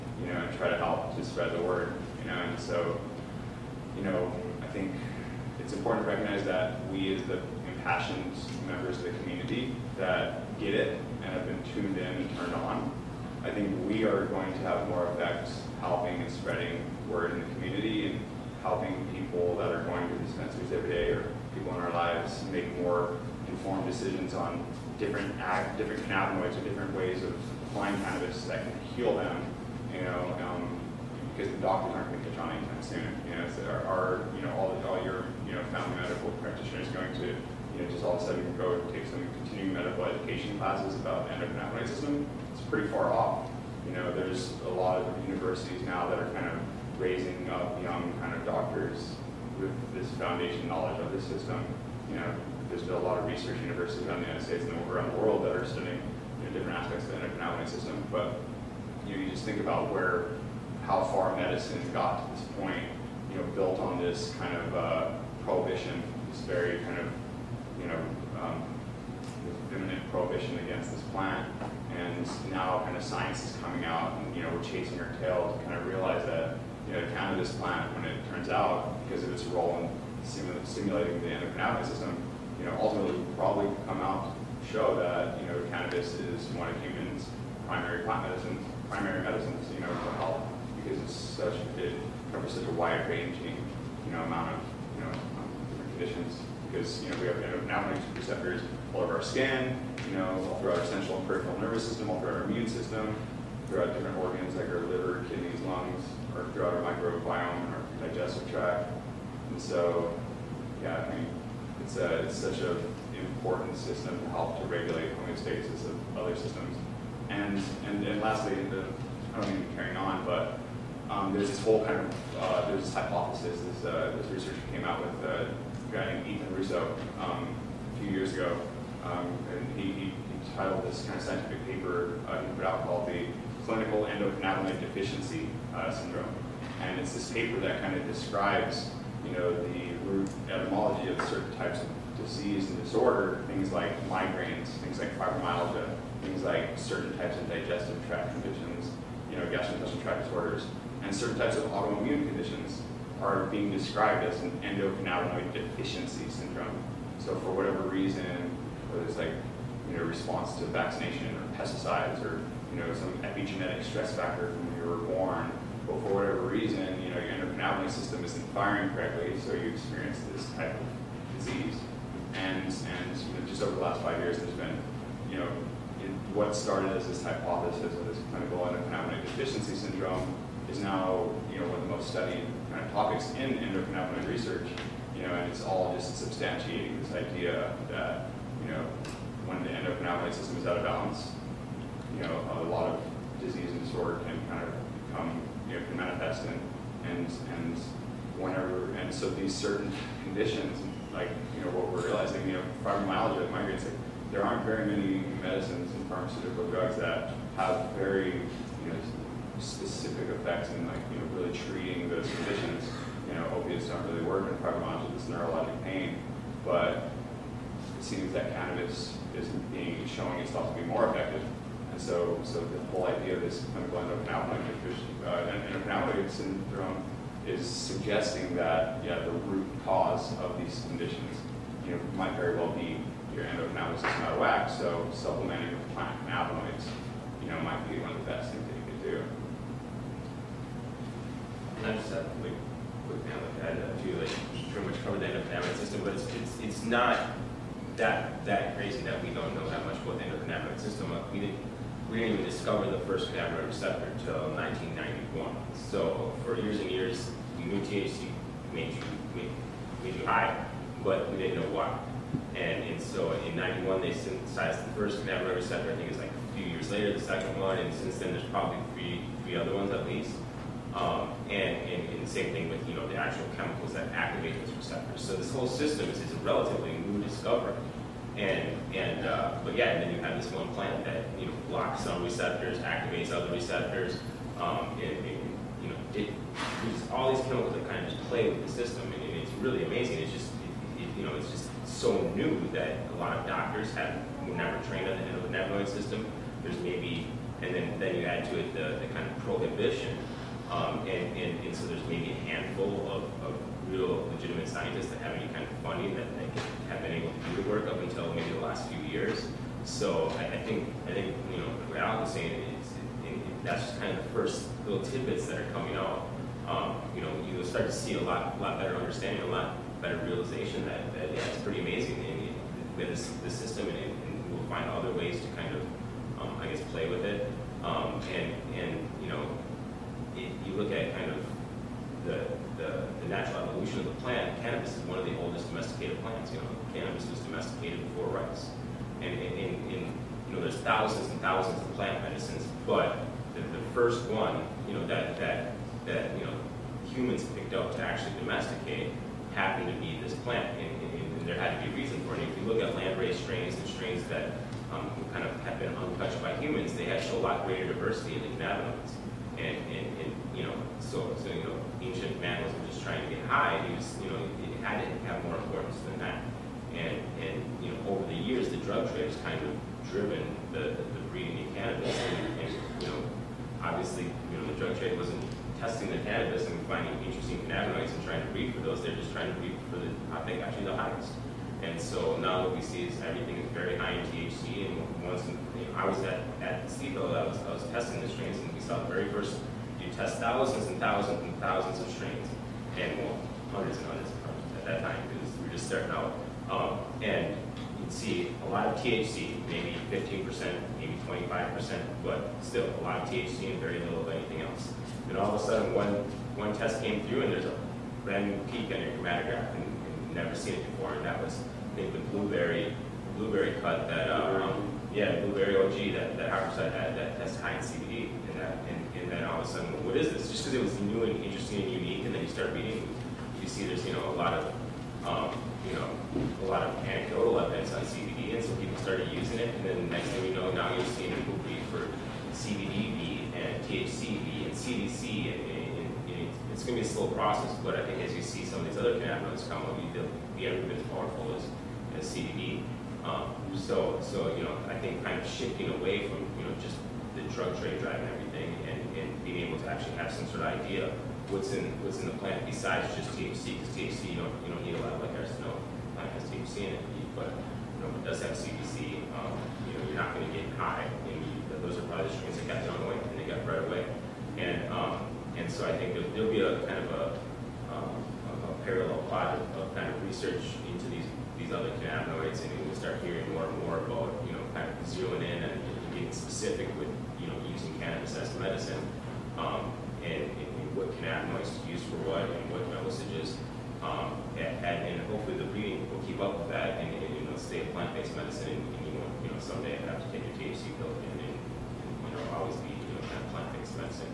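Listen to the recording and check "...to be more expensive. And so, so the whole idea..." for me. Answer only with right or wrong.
wrong.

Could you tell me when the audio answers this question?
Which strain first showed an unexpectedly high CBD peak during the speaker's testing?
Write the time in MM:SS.
06:55.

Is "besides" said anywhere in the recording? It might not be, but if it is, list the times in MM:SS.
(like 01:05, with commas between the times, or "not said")
07:32.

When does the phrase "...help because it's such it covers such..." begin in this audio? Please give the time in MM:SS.
01:30.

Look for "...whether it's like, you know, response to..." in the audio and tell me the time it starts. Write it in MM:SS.
02:38.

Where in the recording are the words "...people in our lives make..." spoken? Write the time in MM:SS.
00:21.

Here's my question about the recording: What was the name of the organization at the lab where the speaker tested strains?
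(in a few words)
SIBO.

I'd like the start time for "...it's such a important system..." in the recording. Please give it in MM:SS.
01:52.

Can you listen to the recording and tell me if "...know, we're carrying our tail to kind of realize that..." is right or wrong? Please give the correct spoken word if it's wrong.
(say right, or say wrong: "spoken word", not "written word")
wrong: "chasing", not "carrying".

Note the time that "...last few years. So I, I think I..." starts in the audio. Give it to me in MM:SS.
05:08.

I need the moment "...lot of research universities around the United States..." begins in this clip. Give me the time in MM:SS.
00:52.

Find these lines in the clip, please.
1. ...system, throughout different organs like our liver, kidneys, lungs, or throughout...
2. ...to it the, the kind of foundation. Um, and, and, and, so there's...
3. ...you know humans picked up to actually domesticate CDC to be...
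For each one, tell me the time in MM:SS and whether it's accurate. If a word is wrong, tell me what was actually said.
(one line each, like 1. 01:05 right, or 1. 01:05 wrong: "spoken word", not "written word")
1. 01:42 right
2. 04:58 wrong: "prohibition", not "foundation"
3. 05:46 wrong: "Happened", not "CDC".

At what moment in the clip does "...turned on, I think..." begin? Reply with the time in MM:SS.
00:12.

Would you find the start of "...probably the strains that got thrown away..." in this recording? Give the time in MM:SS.
07:42.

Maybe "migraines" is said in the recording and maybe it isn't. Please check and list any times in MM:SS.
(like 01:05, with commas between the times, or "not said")
02:24, 03:23.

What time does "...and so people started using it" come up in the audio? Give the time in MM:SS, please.
07:08.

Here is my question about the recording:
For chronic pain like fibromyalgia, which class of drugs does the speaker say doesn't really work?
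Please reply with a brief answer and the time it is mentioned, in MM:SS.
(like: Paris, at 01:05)
Opiates, at 03:33.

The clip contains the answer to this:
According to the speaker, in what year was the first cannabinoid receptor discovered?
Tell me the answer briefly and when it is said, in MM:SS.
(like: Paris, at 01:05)
1991, at 04:14.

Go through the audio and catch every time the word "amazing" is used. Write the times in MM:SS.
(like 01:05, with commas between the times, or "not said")
04:49, 05:21.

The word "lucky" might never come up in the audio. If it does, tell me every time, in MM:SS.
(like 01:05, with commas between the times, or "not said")
not said.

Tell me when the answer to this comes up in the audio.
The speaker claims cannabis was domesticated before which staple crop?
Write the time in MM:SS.
05:38.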